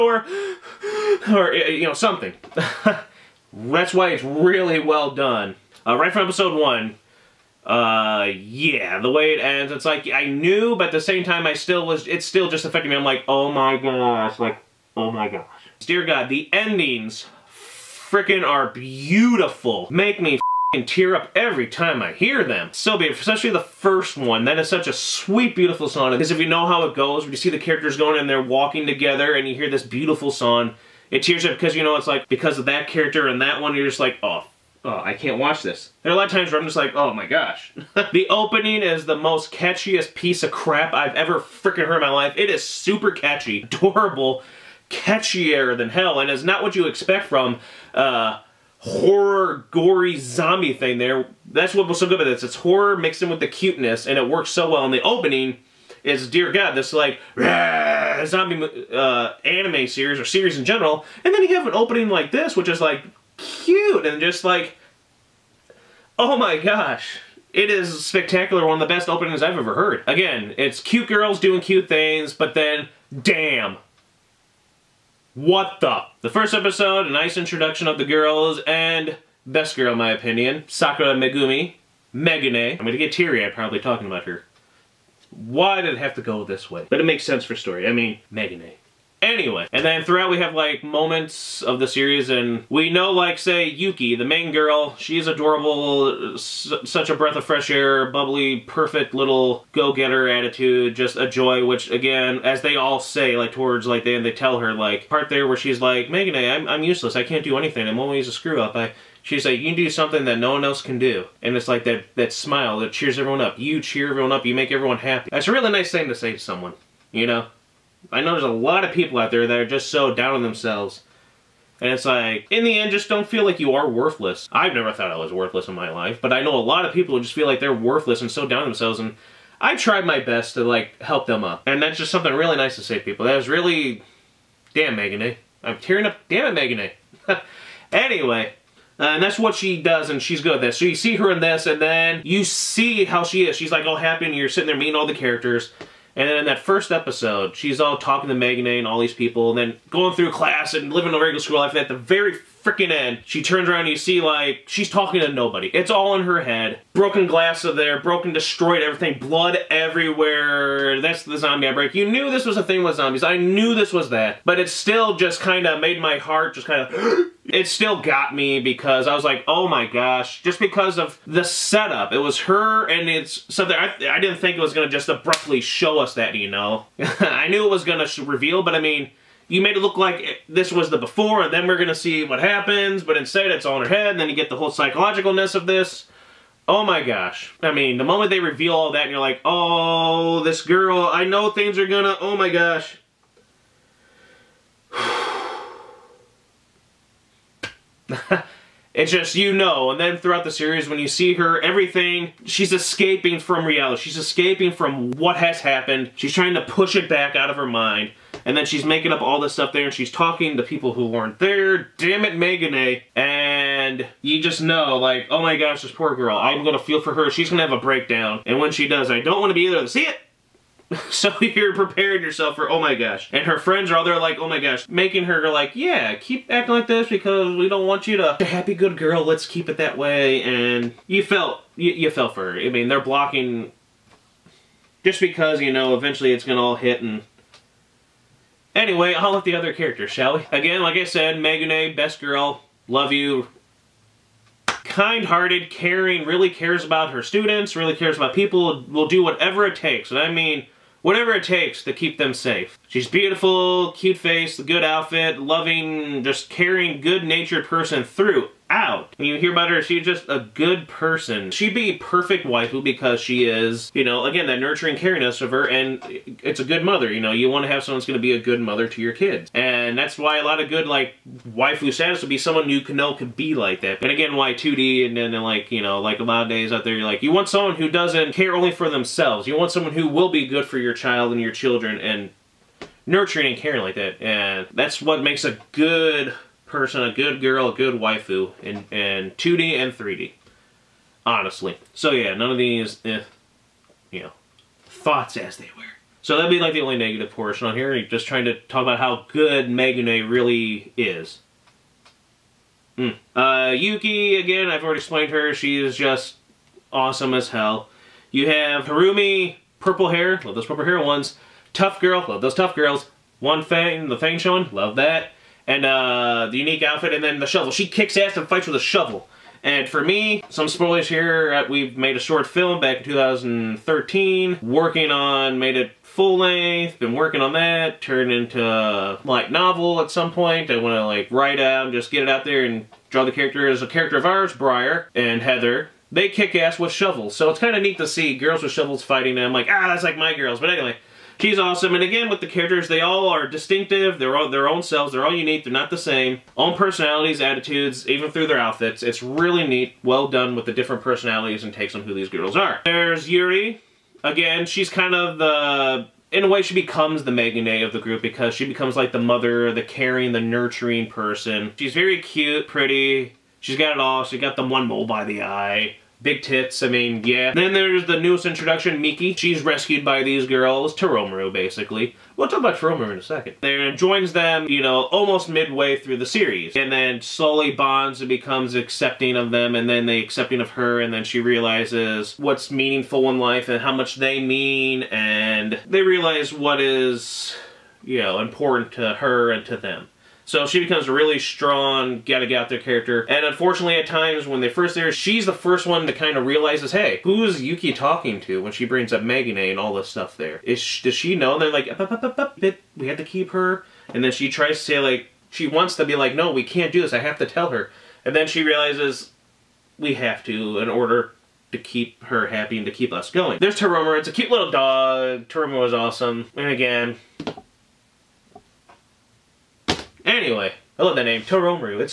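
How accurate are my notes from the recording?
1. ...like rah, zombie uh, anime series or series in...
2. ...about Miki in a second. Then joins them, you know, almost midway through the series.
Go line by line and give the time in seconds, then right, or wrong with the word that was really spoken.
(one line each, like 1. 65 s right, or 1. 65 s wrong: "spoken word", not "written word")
1. 56 s right
2. 372 s wrong: "Taroumaru", not "Miki".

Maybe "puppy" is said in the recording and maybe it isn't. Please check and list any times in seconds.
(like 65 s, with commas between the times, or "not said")
not said.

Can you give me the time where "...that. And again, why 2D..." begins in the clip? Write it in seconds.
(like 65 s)
273 s.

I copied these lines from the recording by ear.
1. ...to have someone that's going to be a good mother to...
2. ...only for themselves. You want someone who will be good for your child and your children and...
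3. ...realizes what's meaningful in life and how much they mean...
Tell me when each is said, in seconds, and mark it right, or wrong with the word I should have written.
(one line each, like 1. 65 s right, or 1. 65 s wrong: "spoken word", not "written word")
1. 267 s right
2. 278 s right
3. 381 s right.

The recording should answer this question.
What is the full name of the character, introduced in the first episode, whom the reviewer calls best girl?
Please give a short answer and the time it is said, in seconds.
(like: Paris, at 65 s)
Sakura Megumi, at 80 s.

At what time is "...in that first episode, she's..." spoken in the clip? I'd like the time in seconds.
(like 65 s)
146 s.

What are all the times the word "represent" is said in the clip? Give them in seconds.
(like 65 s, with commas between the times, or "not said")
not said.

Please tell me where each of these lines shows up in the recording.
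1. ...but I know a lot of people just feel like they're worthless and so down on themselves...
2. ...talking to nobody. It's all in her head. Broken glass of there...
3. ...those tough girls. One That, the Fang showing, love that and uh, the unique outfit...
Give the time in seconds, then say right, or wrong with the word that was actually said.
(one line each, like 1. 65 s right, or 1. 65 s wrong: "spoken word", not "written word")
1. 126 s right
2. 154 s right
3. 312 s wrong: "Fang", not "That".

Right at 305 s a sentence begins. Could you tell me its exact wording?
She is just awesome as hell.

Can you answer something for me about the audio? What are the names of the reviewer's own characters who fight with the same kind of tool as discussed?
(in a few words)
Briar and Heather.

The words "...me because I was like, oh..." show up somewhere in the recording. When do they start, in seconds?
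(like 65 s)
168 s.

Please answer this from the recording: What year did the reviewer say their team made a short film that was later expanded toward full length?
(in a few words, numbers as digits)
2013.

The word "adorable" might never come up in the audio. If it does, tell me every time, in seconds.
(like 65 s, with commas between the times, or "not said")
43 s, 95 s.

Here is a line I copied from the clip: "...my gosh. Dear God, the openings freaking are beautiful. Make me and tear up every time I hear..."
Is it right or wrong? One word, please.
wrong.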